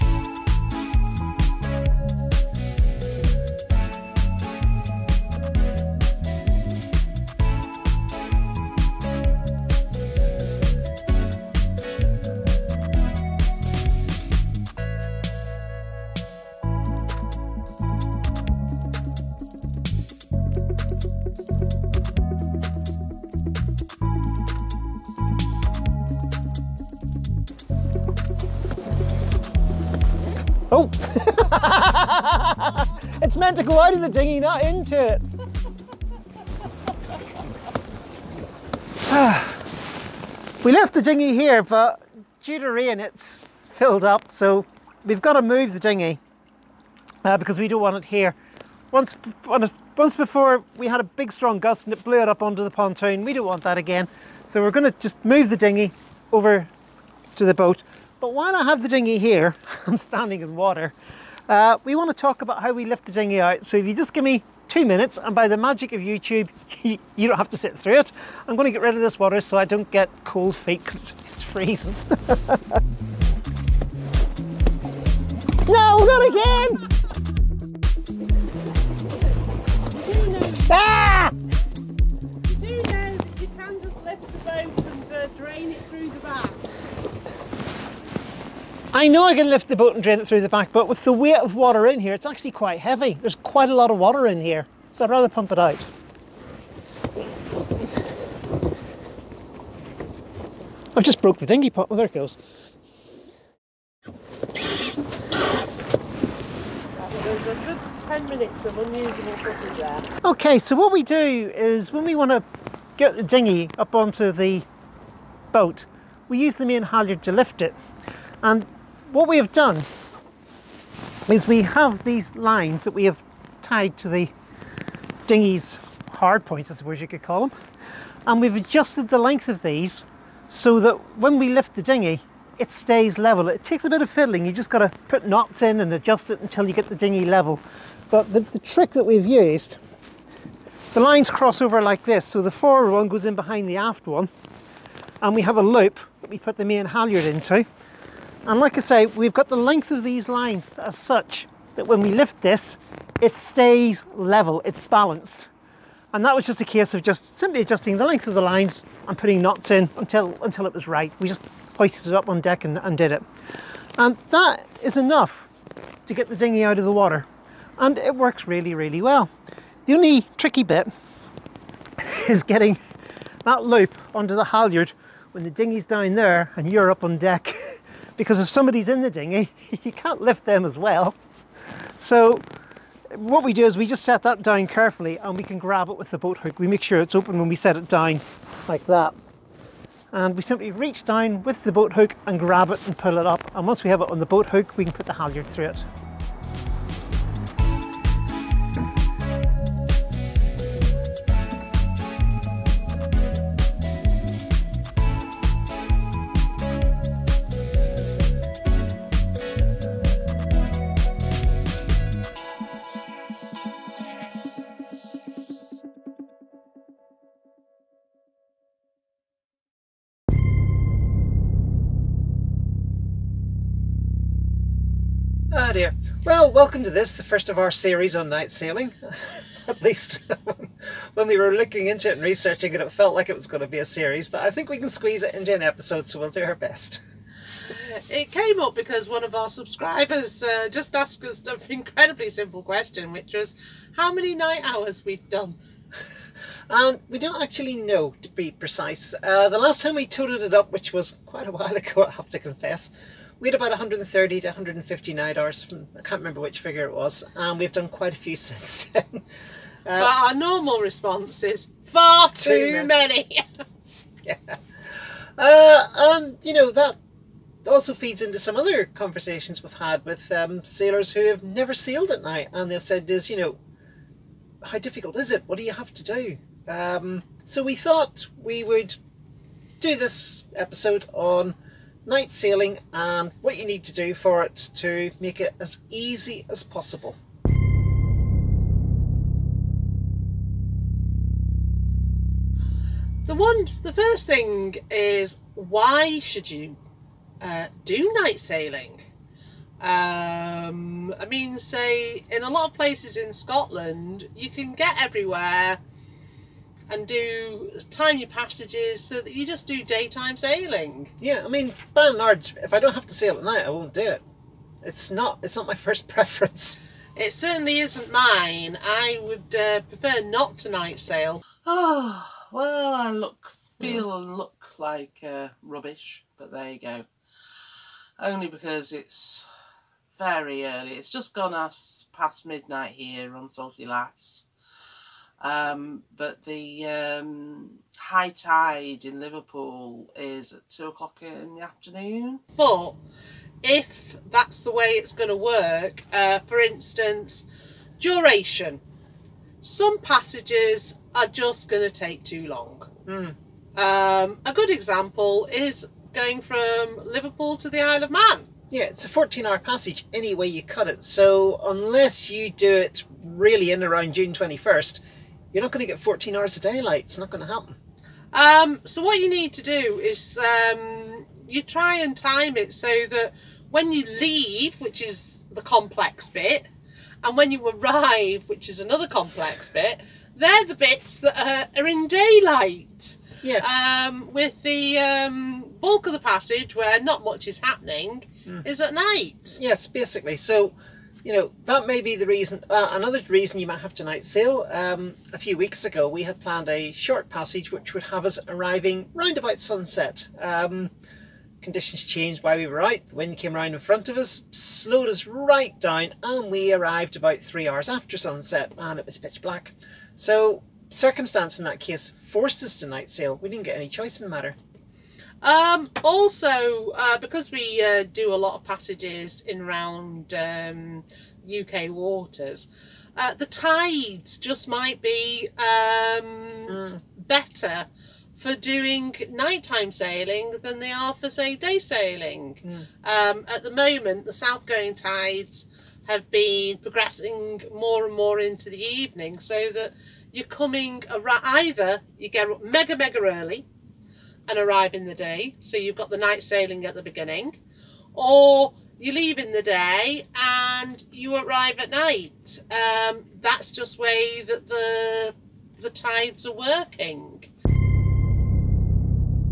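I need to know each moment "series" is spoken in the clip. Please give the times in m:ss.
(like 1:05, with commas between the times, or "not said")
3:47, 3:53.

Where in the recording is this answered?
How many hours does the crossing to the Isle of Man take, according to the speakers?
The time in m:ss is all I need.
5:59.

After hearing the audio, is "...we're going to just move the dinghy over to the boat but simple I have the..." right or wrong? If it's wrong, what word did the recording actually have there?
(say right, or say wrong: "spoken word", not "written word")
wrong: "while", not "simple".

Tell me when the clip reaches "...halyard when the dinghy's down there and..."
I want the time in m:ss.
2:54.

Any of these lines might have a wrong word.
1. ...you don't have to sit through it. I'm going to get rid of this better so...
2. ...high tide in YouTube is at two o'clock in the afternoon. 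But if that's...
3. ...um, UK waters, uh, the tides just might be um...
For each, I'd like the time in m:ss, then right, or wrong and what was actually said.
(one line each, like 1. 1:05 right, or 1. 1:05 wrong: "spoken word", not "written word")
1. 1:06 wrong: "water", not "better"
2. 5:37 wrong: "Liverpool", not "YouTube"
3. 7:00 right.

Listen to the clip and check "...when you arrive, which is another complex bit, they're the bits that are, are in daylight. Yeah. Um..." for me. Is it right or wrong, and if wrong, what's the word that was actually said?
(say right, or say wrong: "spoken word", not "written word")
right.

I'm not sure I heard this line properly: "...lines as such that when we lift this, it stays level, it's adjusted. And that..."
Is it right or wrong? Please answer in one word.
wrong.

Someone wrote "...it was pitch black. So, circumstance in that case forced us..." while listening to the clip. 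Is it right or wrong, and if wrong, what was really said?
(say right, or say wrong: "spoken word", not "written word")
right.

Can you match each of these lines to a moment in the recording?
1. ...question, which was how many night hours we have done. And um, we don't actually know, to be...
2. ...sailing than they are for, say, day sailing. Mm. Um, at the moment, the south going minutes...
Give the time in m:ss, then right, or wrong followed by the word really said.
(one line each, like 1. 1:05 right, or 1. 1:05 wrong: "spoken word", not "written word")
1. 4:02 right
2. 7:09 wrong: "tides", not "minutes".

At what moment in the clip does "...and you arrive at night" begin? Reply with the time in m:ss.
7:30.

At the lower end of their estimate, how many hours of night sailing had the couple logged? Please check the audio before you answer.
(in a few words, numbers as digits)
130.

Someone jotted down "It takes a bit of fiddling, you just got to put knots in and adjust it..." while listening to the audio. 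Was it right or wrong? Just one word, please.
right.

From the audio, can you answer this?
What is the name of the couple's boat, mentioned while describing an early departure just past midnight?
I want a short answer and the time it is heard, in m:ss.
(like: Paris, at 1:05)
Salty Lass, at 5:33.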